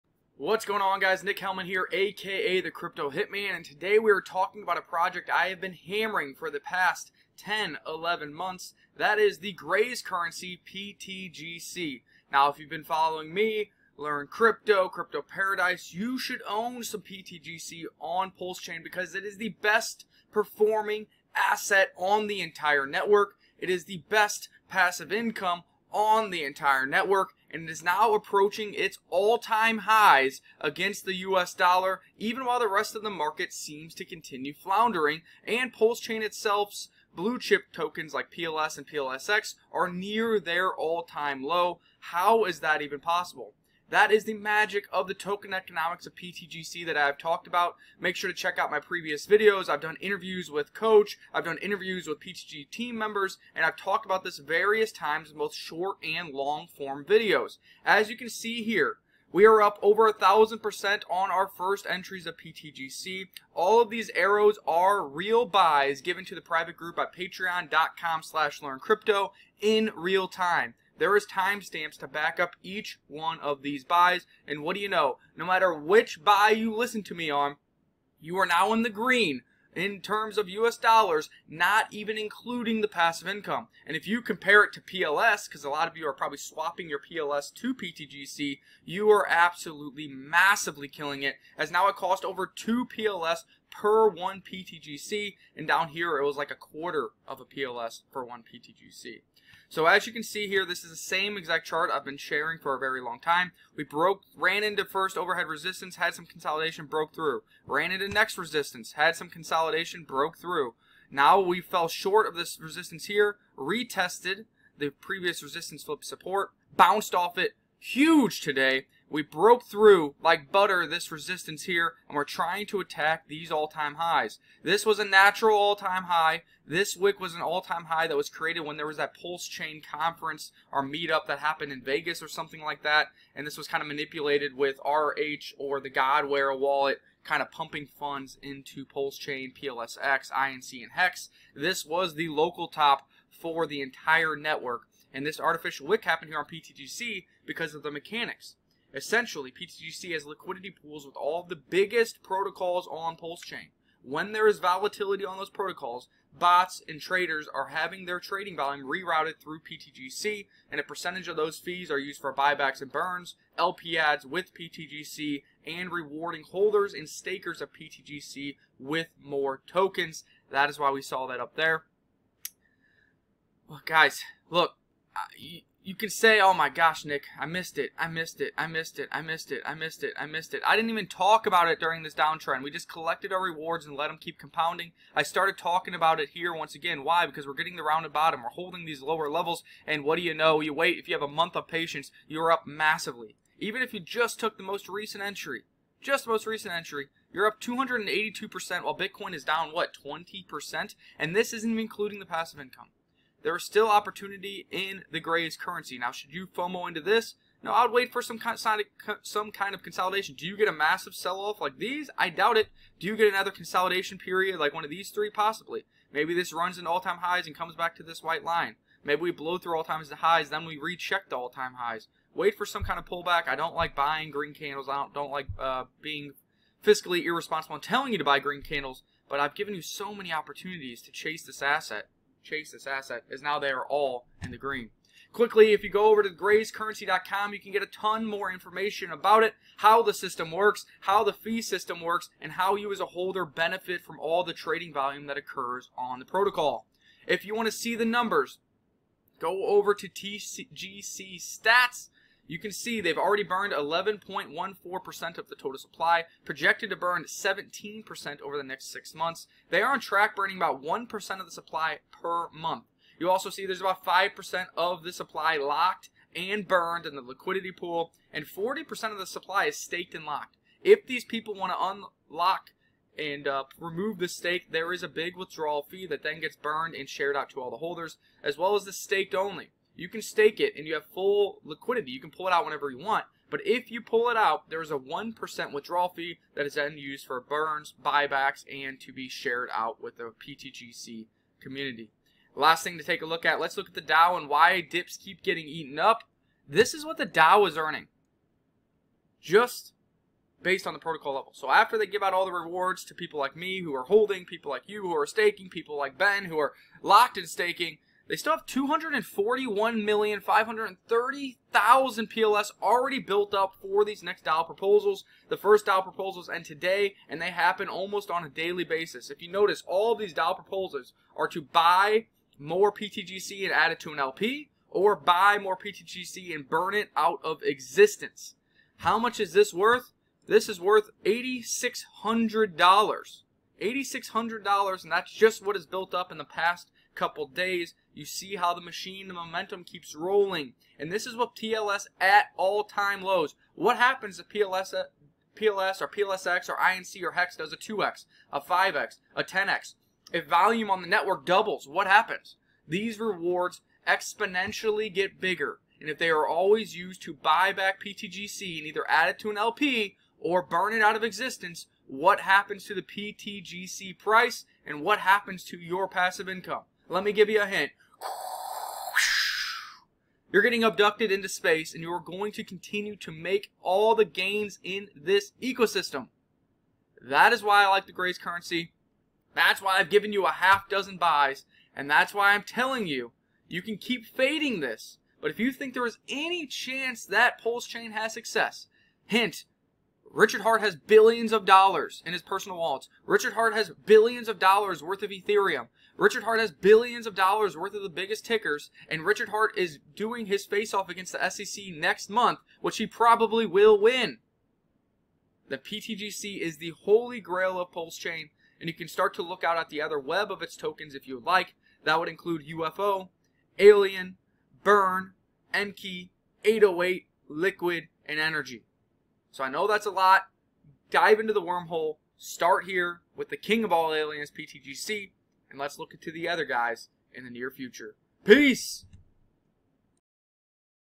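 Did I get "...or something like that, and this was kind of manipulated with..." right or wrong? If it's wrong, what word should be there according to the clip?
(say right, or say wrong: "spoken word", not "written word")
right.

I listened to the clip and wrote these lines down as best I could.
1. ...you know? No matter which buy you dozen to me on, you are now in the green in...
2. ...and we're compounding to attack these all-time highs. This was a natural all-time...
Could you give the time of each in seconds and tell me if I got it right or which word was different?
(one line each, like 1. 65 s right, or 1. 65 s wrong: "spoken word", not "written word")
1. 74 s wrong: "listen", not "dozen"
2. 122 s wrong: "trying", not "compounding".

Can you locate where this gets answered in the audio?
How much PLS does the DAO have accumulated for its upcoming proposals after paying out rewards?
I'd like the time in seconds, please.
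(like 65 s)
308 s.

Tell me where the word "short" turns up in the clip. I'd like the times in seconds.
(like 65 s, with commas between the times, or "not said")
55 s, 111 s.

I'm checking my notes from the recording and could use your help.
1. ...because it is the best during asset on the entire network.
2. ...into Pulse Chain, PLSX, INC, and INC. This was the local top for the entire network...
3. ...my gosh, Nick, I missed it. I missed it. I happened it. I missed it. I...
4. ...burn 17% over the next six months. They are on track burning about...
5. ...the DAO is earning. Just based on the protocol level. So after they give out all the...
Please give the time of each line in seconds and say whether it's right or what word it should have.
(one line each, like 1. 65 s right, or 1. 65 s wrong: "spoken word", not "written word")
1. 18 s wrong: "performing", not "during"
2. 138 s wrong: "HEX", not "INC"
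3. 176 s wrong: "missed", not "happened"
4. 256 s right
5. 297 s right.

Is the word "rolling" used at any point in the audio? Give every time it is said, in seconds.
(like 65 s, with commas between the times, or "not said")
340 s.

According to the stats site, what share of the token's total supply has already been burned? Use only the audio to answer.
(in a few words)
11.14%.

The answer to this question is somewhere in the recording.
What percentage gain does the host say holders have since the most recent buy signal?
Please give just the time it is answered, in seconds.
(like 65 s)
197 s.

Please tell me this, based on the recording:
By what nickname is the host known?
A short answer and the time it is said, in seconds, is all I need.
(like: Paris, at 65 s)
the Crypto Hitman, at 2 s.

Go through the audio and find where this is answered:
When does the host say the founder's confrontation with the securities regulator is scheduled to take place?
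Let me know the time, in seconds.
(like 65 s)
401 s.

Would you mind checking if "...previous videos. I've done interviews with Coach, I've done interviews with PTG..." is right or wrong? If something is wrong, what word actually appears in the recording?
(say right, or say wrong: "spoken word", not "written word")
right.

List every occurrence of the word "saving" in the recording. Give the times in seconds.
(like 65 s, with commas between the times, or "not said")
not said.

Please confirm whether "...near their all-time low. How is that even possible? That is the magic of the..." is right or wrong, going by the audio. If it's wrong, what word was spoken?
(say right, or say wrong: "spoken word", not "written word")
right.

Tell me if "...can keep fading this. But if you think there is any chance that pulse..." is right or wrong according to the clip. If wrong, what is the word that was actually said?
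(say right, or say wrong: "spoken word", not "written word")
right.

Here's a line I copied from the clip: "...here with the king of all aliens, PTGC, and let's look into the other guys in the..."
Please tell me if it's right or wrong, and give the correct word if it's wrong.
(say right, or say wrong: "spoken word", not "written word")
right.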